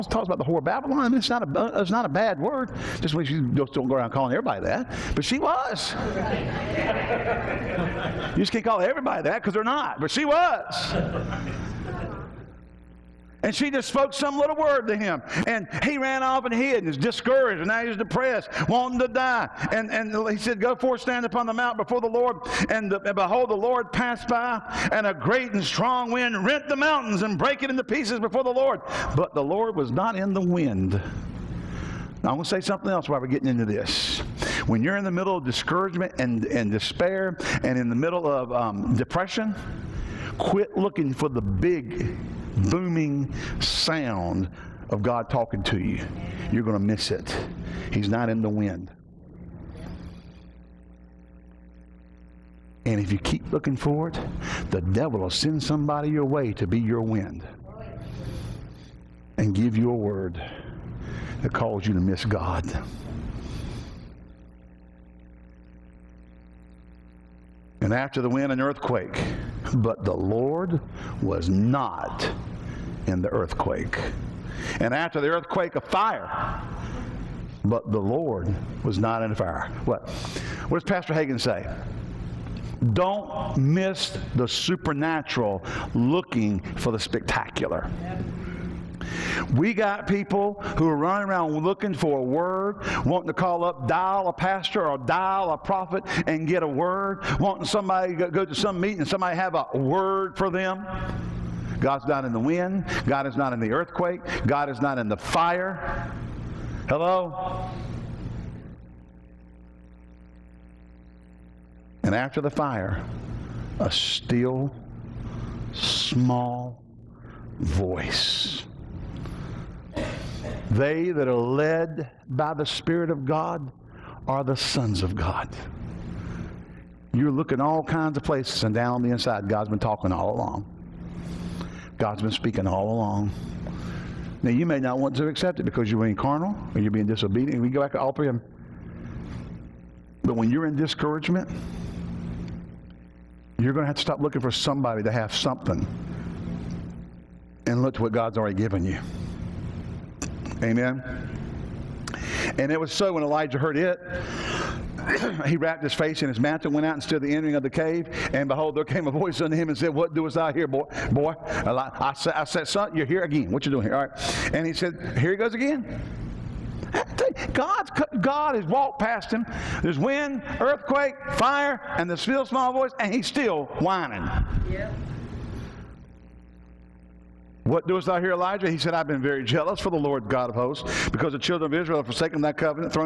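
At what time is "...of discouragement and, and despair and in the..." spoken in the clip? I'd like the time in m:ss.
0:35.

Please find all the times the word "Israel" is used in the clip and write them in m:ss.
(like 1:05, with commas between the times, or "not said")
3:01.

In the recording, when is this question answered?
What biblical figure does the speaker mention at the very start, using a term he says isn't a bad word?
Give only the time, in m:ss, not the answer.
0:00.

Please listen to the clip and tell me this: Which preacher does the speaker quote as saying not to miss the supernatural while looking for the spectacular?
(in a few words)
Pastor Hagin.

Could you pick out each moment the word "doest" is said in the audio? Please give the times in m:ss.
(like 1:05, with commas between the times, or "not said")
2:40, 2:57.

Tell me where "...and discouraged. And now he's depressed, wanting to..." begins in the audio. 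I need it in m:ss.
0:16.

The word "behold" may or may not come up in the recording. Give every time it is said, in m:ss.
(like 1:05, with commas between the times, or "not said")
0:23, 2:38.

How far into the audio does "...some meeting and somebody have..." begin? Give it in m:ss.
1:38.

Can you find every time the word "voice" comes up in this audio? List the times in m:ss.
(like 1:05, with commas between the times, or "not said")
1:57, 2:39, 2:52.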